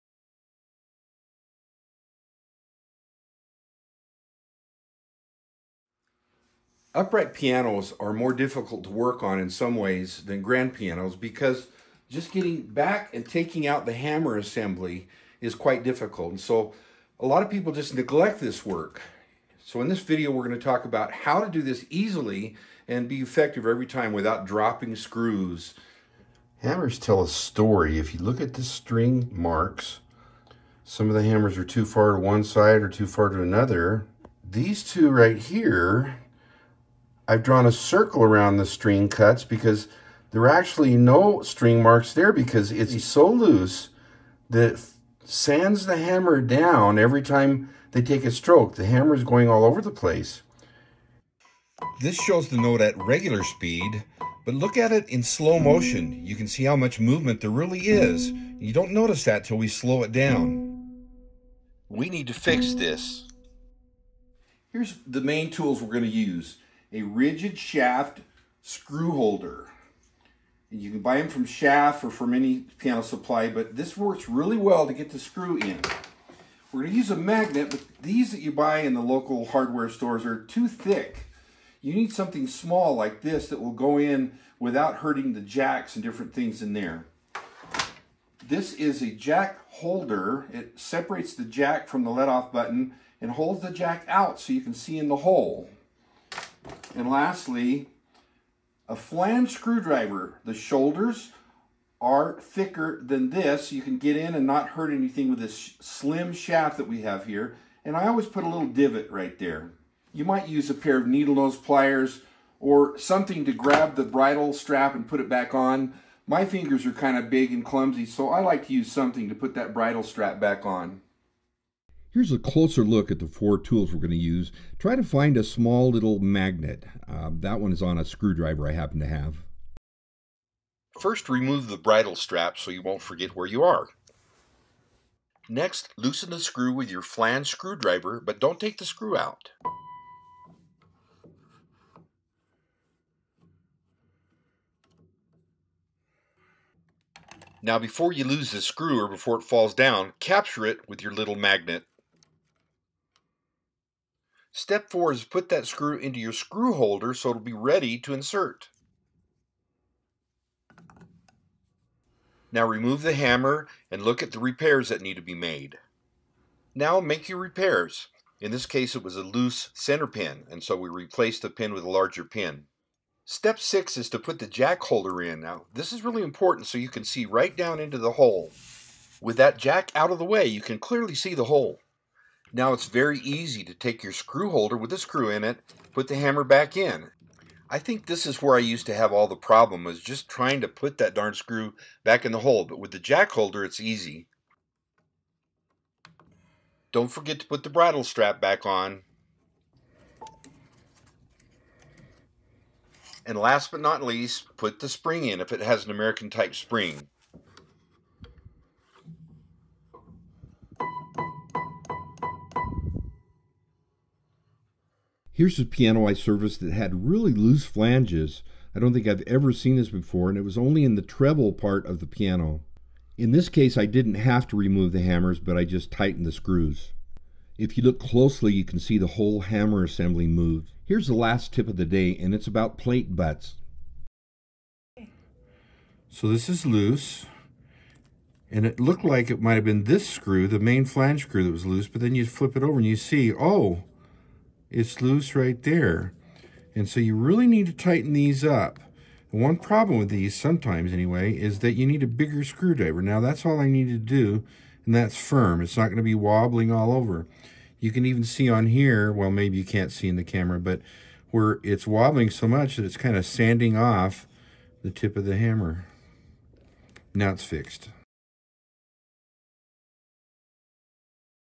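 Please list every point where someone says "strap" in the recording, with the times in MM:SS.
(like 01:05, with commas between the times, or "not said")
01:54, 02:00, 02:12, 03:18.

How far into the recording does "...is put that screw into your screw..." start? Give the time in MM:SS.
02:35.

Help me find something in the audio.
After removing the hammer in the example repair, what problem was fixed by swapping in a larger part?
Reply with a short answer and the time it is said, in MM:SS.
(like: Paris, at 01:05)
loose center pin, at 02:49.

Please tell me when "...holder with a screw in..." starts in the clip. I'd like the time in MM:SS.
03:04.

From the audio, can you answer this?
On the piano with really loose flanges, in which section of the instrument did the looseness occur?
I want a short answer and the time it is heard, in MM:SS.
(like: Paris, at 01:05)
the treble part, at 03:41.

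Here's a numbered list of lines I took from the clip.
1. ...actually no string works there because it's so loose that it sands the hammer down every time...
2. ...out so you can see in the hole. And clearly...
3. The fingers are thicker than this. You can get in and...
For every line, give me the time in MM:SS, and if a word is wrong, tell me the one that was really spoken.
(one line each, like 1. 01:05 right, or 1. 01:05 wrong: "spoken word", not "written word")
1. 00:40 wrong: "marks", not "works"
2. 01:34 wrong: "lastly", not "clearly"
3. 01:40 wrong: "shoulders", not "fingers".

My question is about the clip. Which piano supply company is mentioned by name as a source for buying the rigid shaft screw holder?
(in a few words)
Schaff.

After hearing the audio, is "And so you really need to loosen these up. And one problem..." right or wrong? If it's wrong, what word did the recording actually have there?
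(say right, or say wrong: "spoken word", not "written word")
wrong: "tighten", not "loosen".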